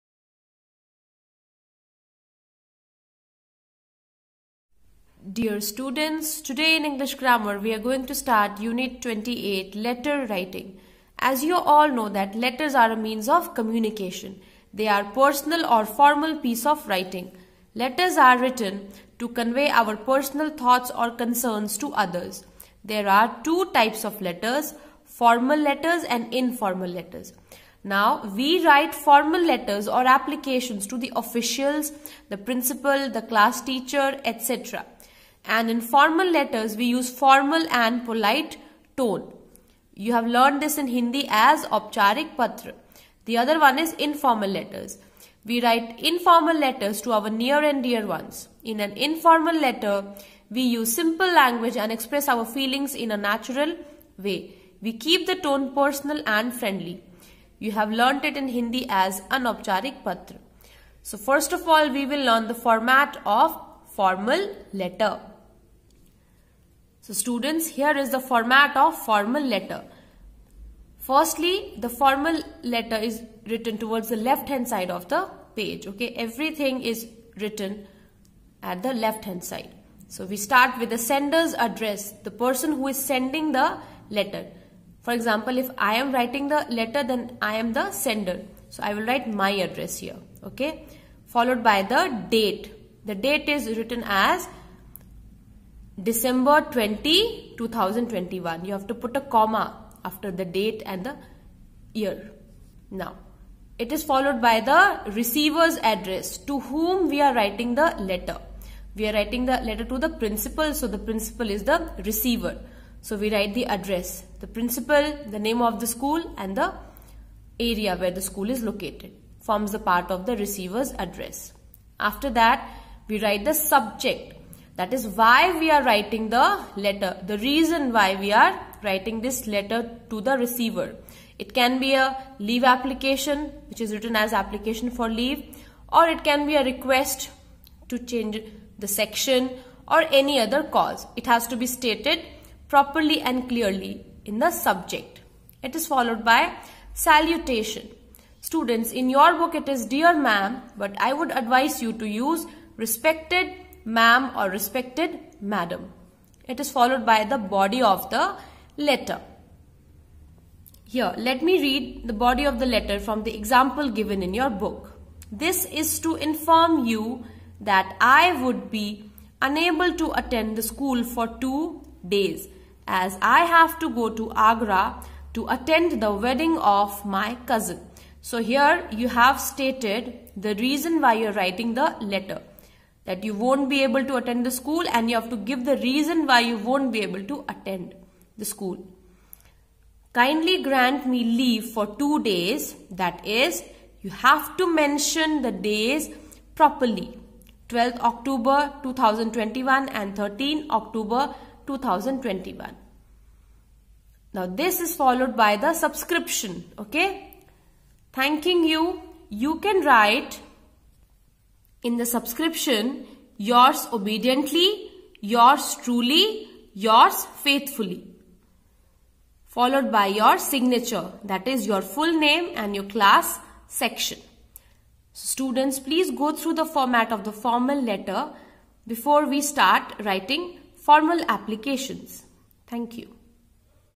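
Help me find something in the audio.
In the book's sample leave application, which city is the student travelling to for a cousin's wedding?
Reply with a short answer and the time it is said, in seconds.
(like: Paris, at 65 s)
Agra, at 174 s.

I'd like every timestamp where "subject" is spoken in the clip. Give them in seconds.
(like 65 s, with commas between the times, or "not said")
123 s, 144 s.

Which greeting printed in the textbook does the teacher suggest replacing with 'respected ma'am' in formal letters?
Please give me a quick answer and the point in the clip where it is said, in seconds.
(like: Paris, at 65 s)
dear ma'am, at 149 s.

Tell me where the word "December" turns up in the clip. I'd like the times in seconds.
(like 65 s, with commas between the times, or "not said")
96 s.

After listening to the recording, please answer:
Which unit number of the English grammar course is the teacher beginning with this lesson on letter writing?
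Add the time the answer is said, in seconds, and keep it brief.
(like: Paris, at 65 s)
28, at 9 s.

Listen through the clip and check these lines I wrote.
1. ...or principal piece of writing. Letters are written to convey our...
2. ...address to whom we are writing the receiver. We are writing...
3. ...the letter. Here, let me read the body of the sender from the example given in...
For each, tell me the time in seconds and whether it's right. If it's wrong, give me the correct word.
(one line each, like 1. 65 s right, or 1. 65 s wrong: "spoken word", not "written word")
1. 15 s wrong: "formal", not "principal"
2. 105 s wrong: "letter", not "receiver"
3. 158 s wrong: "letter", not "sender".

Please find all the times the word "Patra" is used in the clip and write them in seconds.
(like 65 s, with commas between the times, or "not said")
42 s, 60 s.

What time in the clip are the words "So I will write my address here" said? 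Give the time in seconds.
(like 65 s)
88 s.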